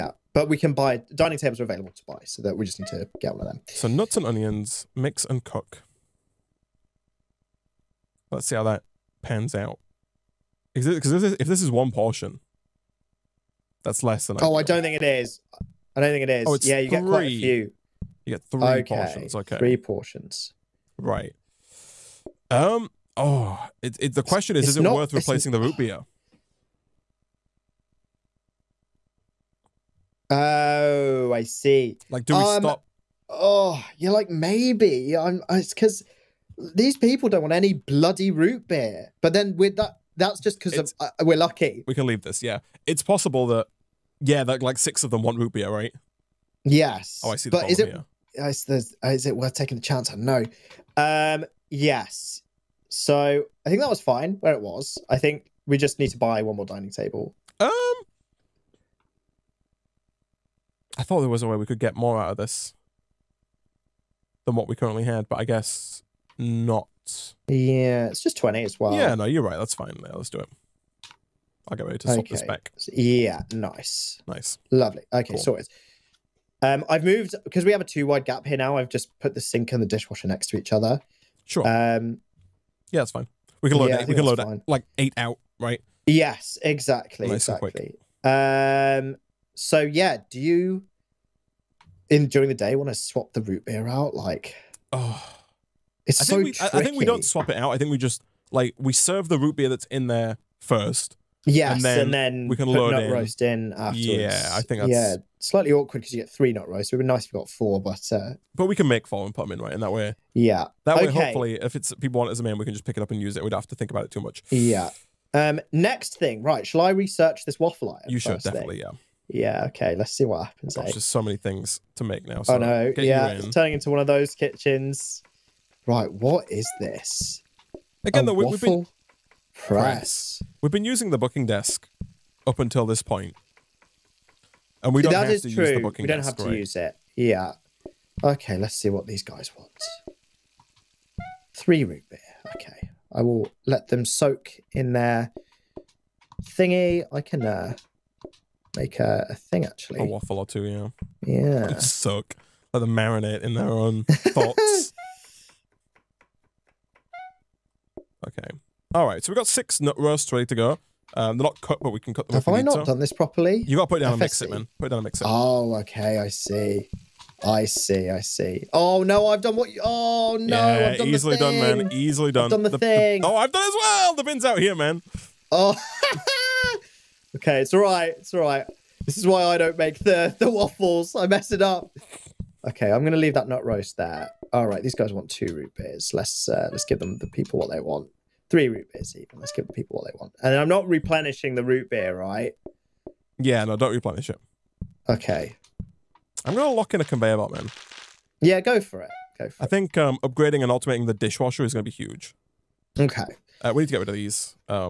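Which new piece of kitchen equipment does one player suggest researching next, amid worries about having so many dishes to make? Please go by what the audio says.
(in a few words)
waffle iron.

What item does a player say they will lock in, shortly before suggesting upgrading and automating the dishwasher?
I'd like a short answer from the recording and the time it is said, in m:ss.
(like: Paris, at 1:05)
conveyor belt, at 3:17.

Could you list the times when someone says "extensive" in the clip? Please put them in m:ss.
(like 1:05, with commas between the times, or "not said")
not said.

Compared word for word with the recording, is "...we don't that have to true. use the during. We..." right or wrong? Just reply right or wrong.
wrong.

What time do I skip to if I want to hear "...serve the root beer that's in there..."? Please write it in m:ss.
1:38.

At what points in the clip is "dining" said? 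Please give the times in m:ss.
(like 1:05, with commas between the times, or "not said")
0:01, 0:56.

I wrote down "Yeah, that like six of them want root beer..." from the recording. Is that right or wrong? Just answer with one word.
right.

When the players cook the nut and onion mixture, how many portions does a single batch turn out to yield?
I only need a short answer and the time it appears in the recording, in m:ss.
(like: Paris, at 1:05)
3, at 0:19.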